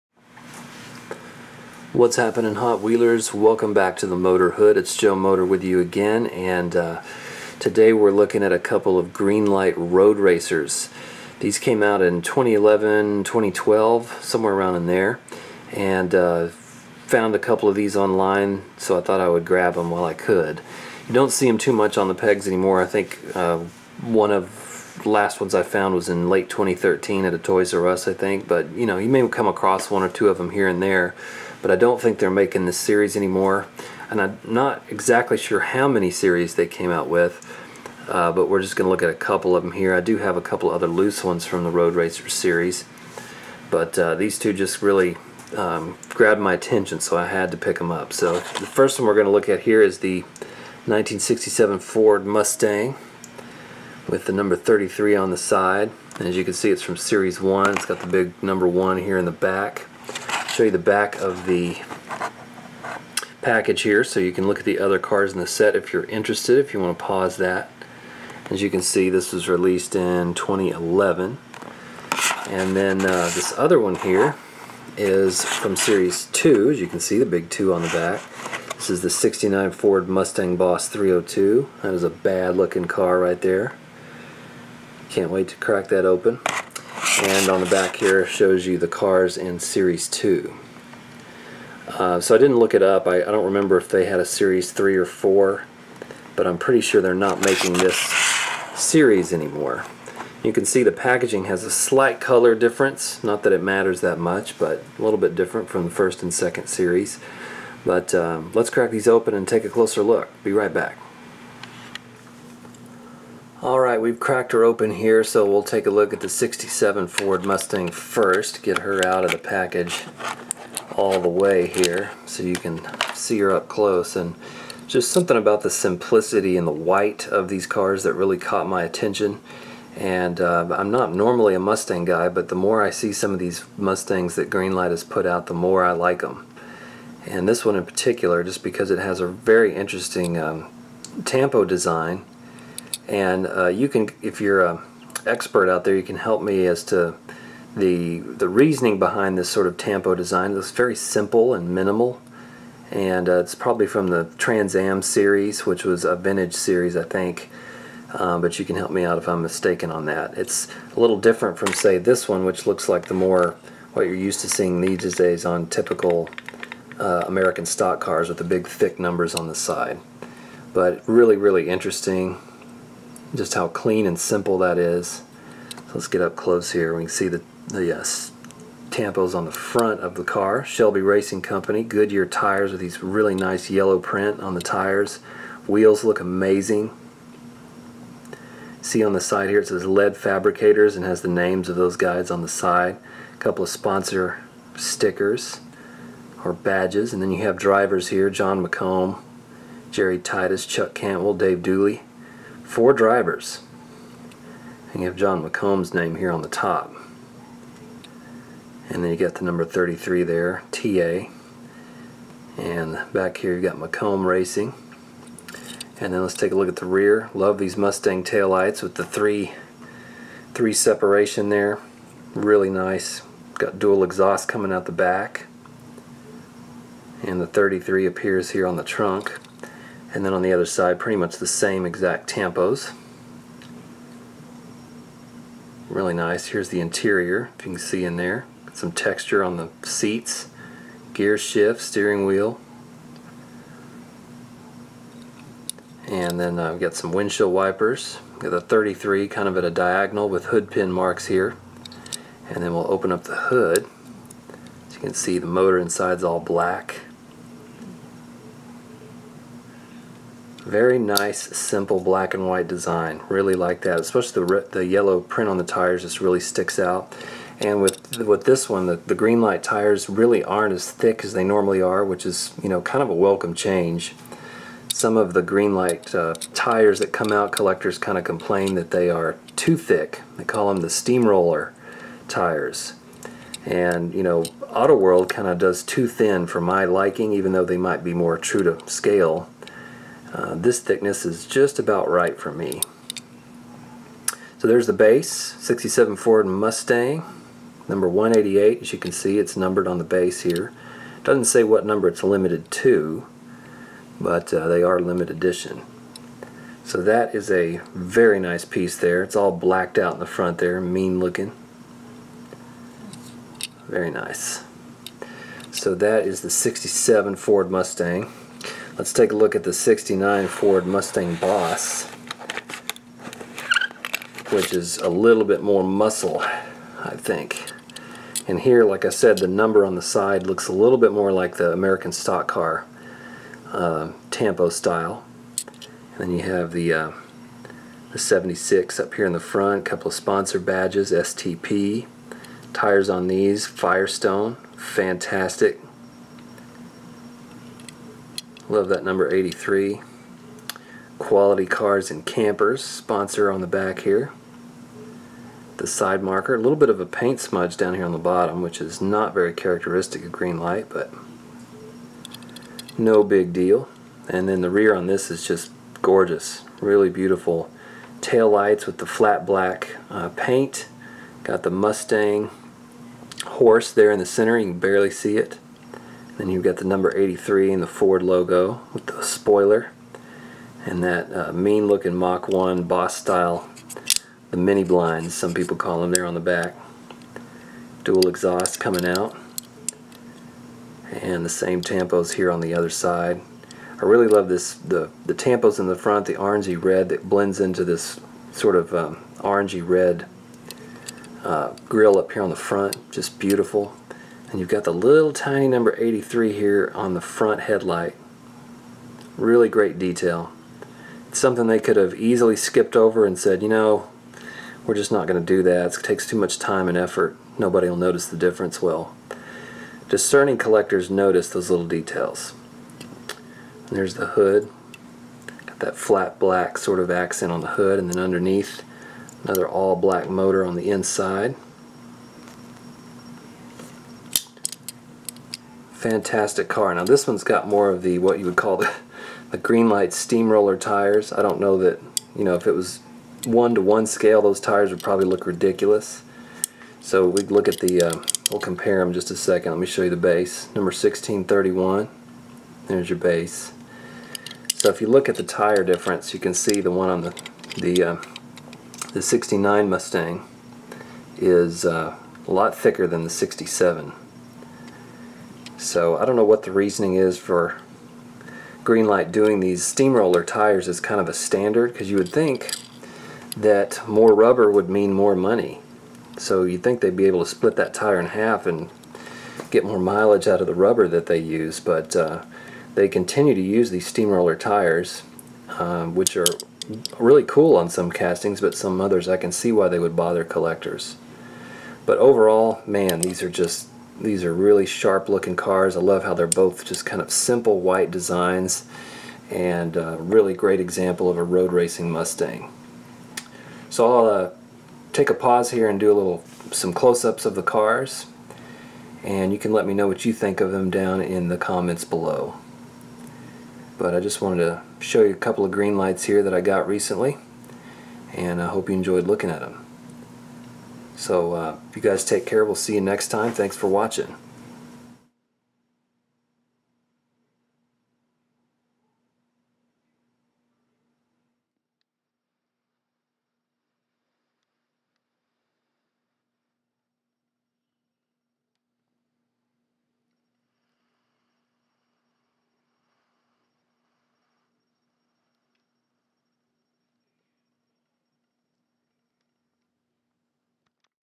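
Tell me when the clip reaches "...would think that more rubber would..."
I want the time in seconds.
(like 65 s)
472 s.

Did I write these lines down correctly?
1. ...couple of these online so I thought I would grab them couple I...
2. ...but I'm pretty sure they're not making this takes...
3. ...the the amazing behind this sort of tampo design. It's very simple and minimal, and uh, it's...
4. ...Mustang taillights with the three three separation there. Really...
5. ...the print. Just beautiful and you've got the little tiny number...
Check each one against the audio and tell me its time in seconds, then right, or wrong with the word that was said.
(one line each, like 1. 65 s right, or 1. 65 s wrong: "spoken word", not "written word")
1. 17 s wrong: "while", not "couple"
2. 96 s wrong: "series", not "takes"
3. 147 s wrong: "reasoning", not "amazing"
4. 217 s right
5. 402 s wrong: "front", not "print".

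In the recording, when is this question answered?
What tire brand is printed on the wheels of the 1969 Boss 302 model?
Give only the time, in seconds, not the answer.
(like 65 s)
343 s.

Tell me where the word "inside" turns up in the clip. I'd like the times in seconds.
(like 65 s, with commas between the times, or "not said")
255 s, 430 s.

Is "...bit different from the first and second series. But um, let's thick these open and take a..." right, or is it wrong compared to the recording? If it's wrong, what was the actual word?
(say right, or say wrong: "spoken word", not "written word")
wrong: "crack", not "thick".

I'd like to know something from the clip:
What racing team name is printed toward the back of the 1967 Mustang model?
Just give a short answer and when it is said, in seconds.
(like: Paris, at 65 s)
McComb Racing, at 213 s.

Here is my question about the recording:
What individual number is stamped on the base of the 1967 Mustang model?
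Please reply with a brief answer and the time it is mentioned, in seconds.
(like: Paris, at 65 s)
188, at 297 s.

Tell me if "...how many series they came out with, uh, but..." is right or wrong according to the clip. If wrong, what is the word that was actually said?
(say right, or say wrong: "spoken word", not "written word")
right.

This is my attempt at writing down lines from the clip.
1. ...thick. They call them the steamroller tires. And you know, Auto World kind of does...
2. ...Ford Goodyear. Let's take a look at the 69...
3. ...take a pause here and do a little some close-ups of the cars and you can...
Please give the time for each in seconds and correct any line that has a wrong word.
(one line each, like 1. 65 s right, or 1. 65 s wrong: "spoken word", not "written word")
1. 279 s right
2. 317 s wrong: "Mustang", not "Goodyear"
3. 505 s right.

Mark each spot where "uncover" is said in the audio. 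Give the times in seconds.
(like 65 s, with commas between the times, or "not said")
not said.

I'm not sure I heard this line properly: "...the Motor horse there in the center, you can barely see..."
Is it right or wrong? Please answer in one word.
wrong.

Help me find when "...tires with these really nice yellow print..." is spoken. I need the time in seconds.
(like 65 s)
182 s.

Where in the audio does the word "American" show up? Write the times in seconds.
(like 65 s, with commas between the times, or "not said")
167 s, 331 s.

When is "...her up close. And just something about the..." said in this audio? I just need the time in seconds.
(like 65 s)
123 s.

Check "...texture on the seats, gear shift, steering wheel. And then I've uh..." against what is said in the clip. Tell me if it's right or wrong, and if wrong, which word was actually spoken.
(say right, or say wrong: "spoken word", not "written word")
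right.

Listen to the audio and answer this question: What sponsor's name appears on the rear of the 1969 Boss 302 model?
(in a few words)
Quality Cars and Campers.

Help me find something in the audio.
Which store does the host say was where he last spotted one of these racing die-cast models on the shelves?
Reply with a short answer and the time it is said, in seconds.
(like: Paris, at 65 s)
Toys R Us, at 27 s.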